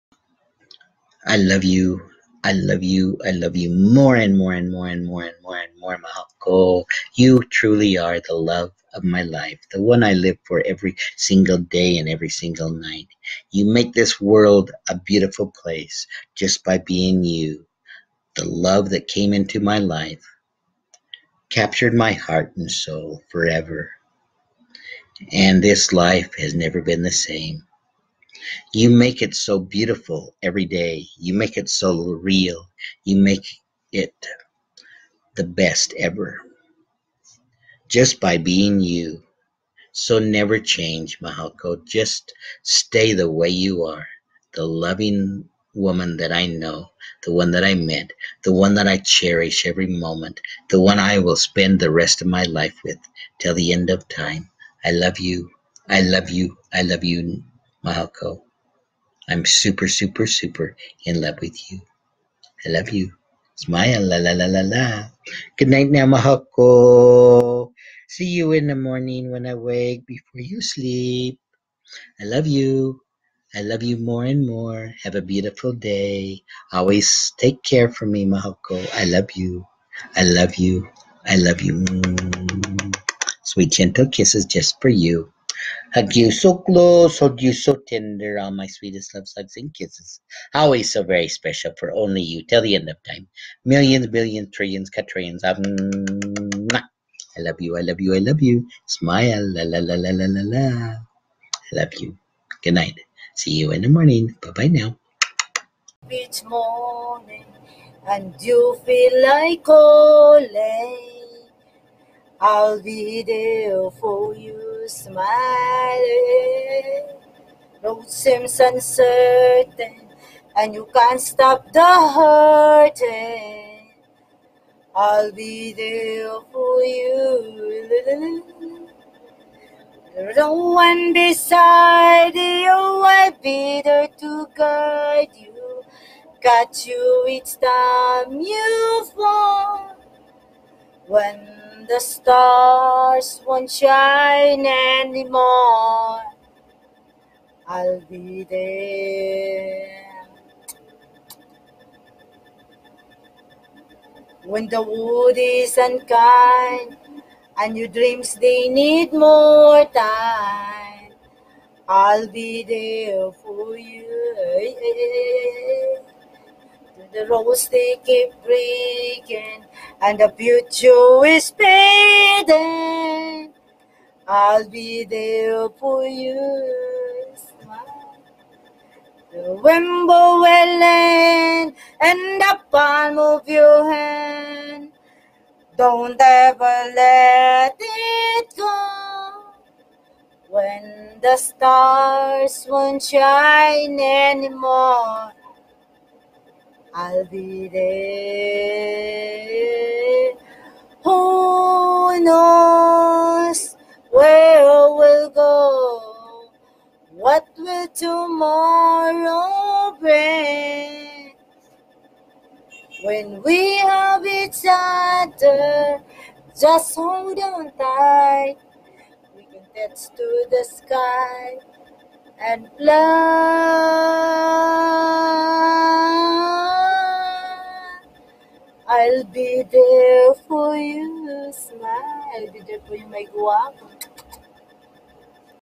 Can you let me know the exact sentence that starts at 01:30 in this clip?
Always so very special for only you till the end of time.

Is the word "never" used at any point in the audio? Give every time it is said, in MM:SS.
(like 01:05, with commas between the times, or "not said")
00:26, 00:40.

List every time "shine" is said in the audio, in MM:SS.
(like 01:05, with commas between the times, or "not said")
02:23, 03:13.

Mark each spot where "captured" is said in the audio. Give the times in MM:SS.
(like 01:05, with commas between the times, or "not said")
00:21.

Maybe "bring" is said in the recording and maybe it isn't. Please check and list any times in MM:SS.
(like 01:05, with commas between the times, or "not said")
03:29.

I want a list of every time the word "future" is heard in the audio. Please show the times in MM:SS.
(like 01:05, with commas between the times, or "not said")
02:50.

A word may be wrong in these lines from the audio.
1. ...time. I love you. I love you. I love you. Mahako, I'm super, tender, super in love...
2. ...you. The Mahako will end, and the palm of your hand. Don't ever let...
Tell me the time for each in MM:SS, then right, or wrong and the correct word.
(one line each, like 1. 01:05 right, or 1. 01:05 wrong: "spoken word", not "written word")
1. 00:54 wrong: "super", not "tender"
2. 02:56 wrong: "Remember", not "Mahako".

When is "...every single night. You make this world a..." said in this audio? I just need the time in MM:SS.
00:12.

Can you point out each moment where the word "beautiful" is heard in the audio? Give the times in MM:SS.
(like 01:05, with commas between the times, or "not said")
00:14, 00:29, 01:15.